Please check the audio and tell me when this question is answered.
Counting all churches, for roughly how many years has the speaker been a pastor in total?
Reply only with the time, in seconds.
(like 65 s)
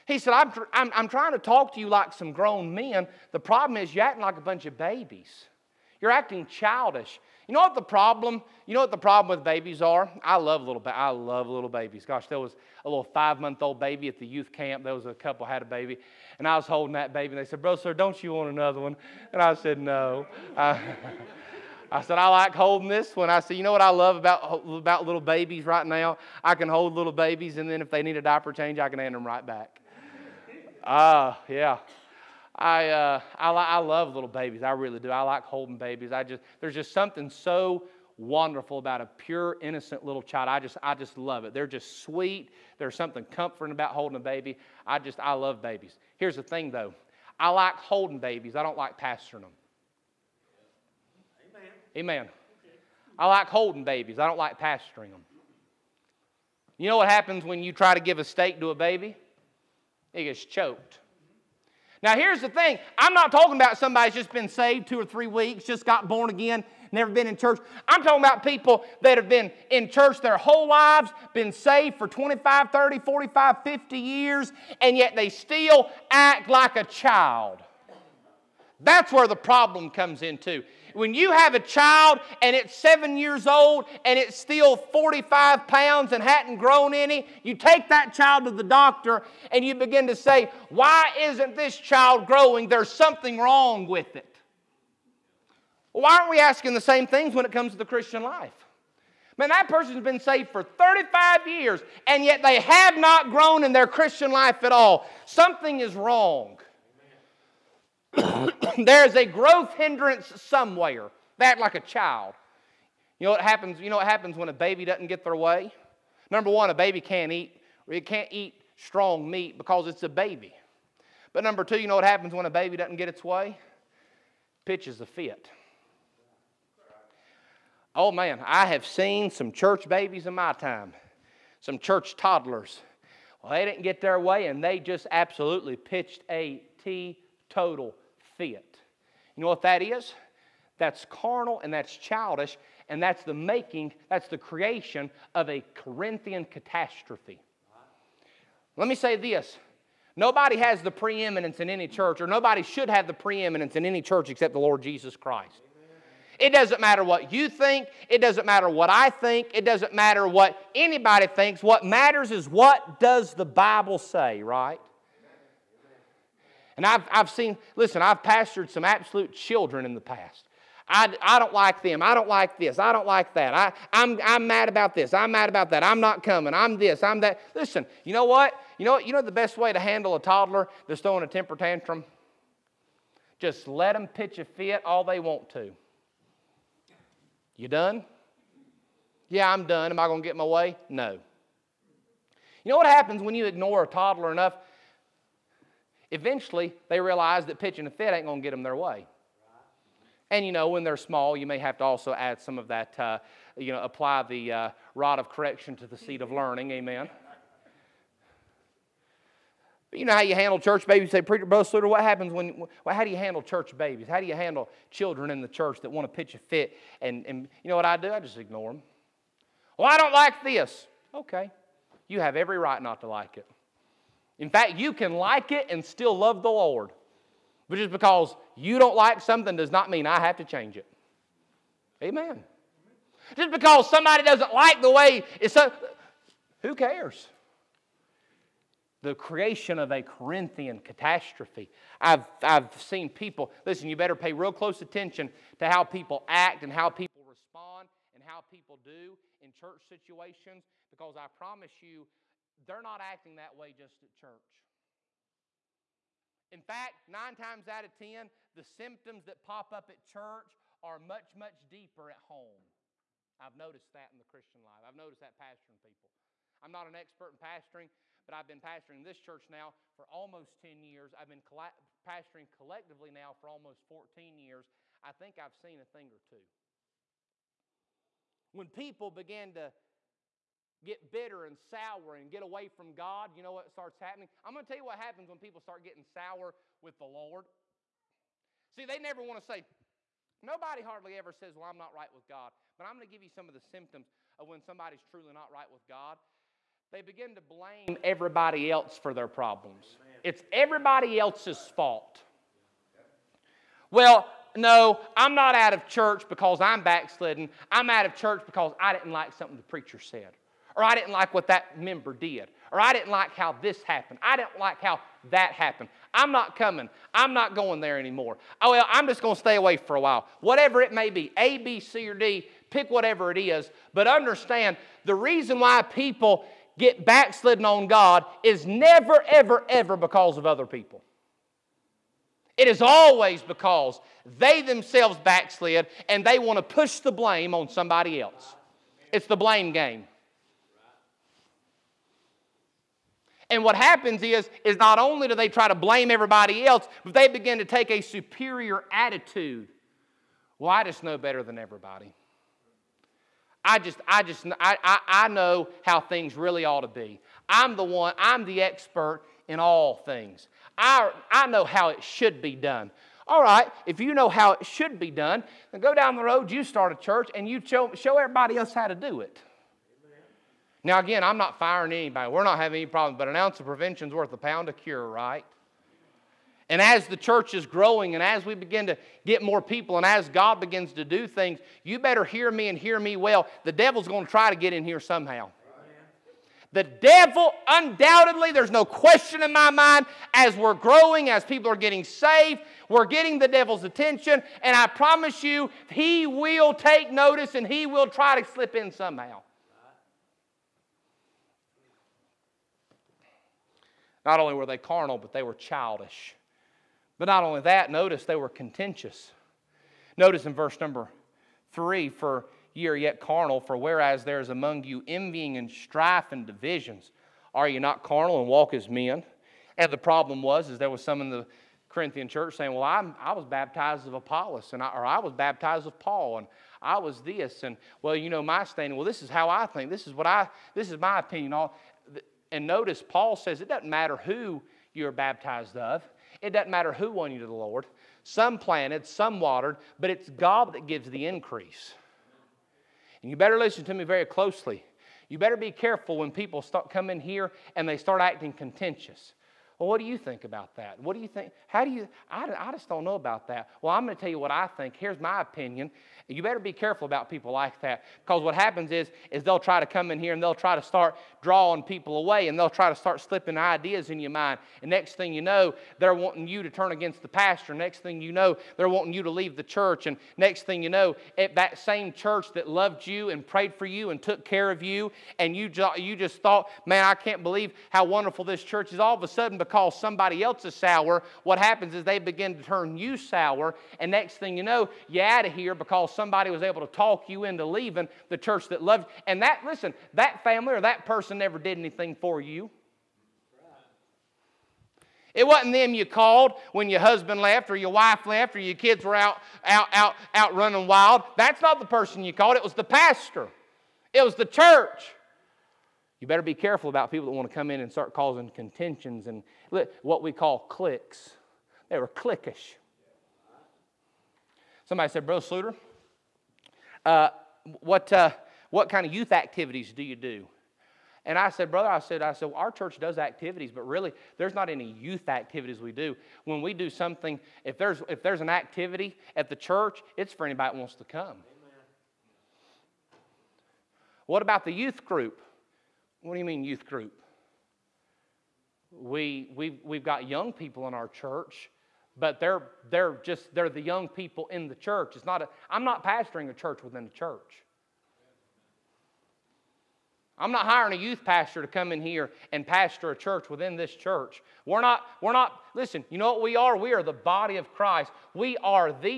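273 s.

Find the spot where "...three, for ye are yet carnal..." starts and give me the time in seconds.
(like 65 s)
411 s.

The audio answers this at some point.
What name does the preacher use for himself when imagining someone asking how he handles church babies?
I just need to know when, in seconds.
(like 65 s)
211 s.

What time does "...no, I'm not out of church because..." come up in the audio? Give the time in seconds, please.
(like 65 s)
304 s.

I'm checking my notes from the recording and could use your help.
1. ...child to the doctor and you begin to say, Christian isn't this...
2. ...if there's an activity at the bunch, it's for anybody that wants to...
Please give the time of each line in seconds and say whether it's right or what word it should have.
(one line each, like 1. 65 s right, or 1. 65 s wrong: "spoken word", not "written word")
1. 88 s wrong: "Why", not "Christian"
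2. 528 s wrong: "church", not "bunch".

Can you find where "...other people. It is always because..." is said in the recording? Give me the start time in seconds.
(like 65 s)
330 s.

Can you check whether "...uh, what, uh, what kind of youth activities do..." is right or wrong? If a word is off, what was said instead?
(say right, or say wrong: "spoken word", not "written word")
right.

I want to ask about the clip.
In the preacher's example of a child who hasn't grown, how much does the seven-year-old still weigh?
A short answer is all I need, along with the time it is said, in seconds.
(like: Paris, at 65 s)
45 pounds, at 84 s.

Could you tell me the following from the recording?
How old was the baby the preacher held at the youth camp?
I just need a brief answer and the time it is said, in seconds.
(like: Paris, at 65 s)
5 months, at 13 s.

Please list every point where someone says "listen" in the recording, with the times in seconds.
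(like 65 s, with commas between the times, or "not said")
167 s, 177 s, 243 s, 443 s, 489 s, 555 s.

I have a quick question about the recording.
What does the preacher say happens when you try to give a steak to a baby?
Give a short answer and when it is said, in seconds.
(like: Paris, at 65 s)
It gets choked, at 60 s.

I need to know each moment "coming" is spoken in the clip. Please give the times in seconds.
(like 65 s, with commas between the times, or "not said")
176 s, 316 s.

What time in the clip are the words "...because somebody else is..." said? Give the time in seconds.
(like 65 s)
479 s.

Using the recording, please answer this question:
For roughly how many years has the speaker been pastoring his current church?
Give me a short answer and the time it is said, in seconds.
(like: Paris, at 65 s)
10 years, at 270 s.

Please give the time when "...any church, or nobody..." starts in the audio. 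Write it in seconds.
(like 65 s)
151 s.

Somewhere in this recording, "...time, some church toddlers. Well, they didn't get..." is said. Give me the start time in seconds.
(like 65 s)
130 s.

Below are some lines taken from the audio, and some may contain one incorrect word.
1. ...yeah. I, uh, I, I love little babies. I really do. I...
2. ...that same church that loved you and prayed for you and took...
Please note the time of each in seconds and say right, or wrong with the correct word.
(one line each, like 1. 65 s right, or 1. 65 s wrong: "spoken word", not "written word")
1. 31 s right
2. 471 s right.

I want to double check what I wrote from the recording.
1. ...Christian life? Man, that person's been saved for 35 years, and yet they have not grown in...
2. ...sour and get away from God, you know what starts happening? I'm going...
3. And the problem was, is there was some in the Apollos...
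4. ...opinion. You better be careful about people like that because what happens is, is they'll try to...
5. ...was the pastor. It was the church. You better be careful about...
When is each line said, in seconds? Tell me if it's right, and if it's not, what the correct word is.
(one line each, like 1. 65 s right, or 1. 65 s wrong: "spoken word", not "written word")
1. 97 s right
2. 281 s right
3. 419 s wrong: "Corinthian", not "Apollos"
4. 455 s right
5. 502 s right.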